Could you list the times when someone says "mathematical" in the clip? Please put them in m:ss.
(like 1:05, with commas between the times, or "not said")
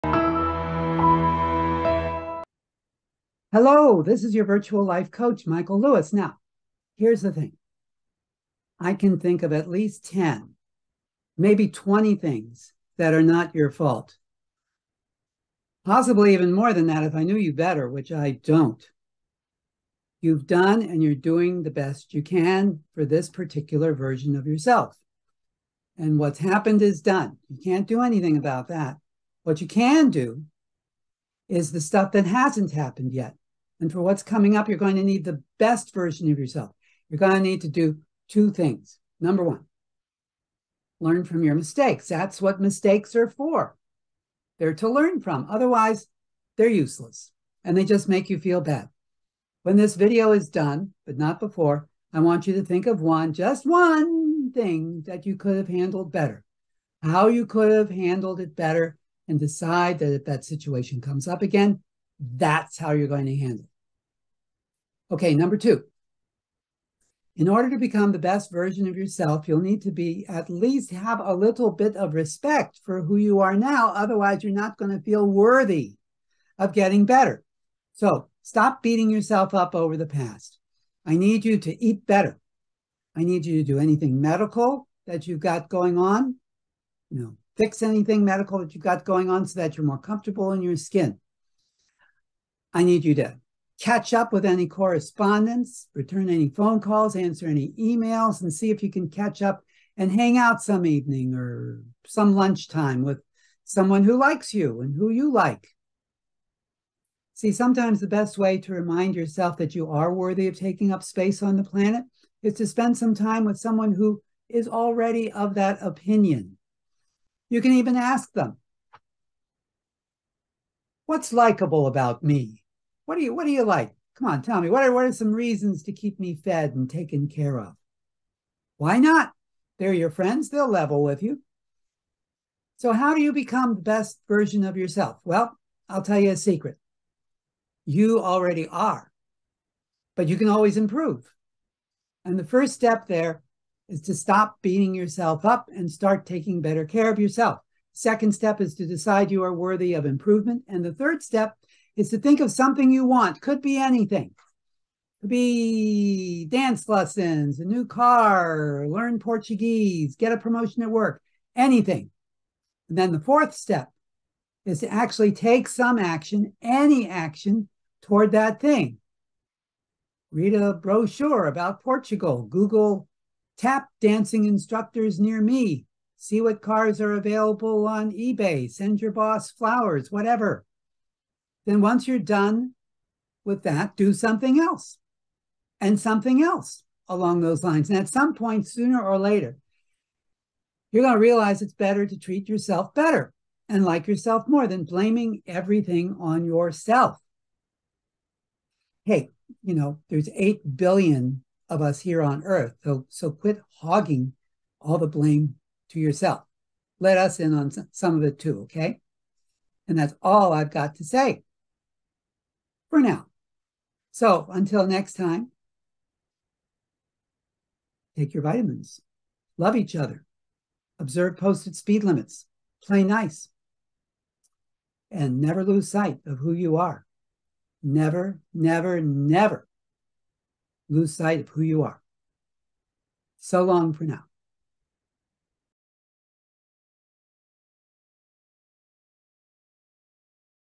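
not said.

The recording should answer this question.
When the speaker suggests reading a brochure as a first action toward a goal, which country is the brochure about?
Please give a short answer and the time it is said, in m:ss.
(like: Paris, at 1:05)
Portugal, at 2:51.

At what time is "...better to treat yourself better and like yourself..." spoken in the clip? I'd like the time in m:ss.
3:11.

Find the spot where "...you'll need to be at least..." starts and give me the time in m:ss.
1:09.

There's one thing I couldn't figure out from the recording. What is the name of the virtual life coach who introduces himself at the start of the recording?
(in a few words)
Michael Lewis.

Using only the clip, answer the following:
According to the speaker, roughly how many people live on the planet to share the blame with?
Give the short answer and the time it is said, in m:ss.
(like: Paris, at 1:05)
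8 billion, at 3:20.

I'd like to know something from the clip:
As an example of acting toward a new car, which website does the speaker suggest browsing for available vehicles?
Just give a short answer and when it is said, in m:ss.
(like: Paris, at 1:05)
eBay, at 2:58.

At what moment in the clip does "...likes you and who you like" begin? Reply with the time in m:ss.
1:44.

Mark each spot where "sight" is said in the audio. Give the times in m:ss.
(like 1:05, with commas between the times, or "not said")
3:45, 3:51.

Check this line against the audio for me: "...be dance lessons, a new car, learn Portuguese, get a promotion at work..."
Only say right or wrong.
right.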